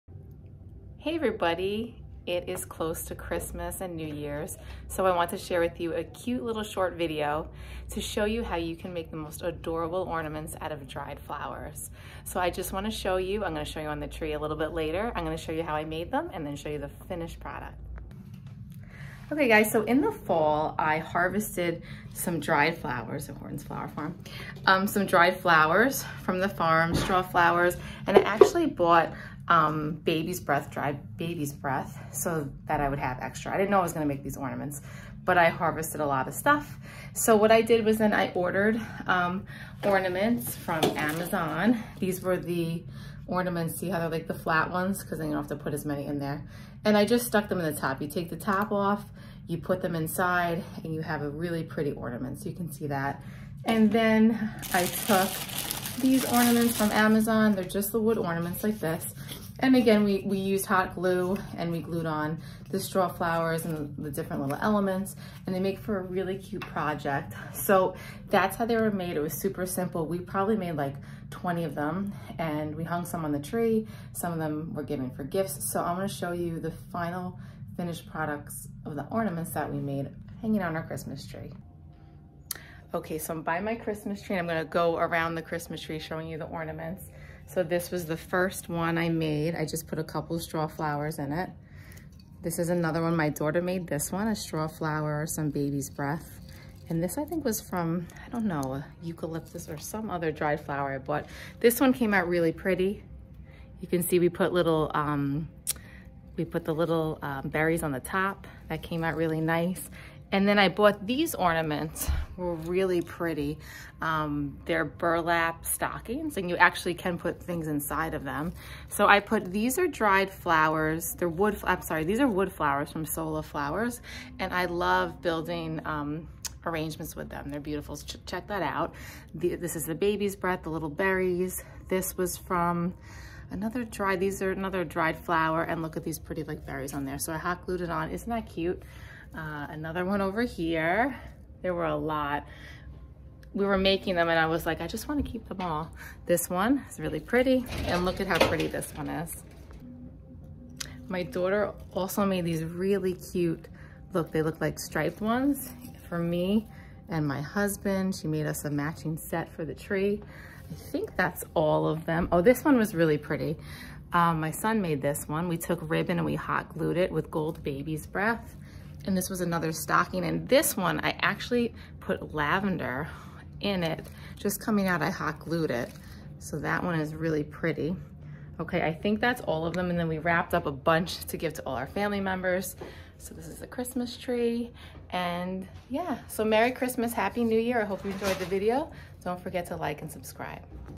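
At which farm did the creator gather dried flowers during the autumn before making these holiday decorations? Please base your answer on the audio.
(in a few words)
Horton's Flower Farm.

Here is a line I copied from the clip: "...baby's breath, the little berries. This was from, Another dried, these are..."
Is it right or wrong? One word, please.
right.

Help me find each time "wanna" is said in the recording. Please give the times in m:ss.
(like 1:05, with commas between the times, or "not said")
0:12, 2:25.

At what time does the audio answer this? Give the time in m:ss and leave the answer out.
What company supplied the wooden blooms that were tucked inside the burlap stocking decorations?
2:03.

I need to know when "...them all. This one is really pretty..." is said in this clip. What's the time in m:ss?
2:25.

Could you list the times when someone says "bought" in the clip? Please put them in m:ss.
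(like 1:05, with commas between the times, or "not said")
0:28, 1:40, 1:50.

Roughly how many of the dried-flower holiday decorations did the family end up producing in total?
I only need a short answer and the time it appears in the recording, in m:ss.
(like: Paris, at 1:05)
20, at 1:11.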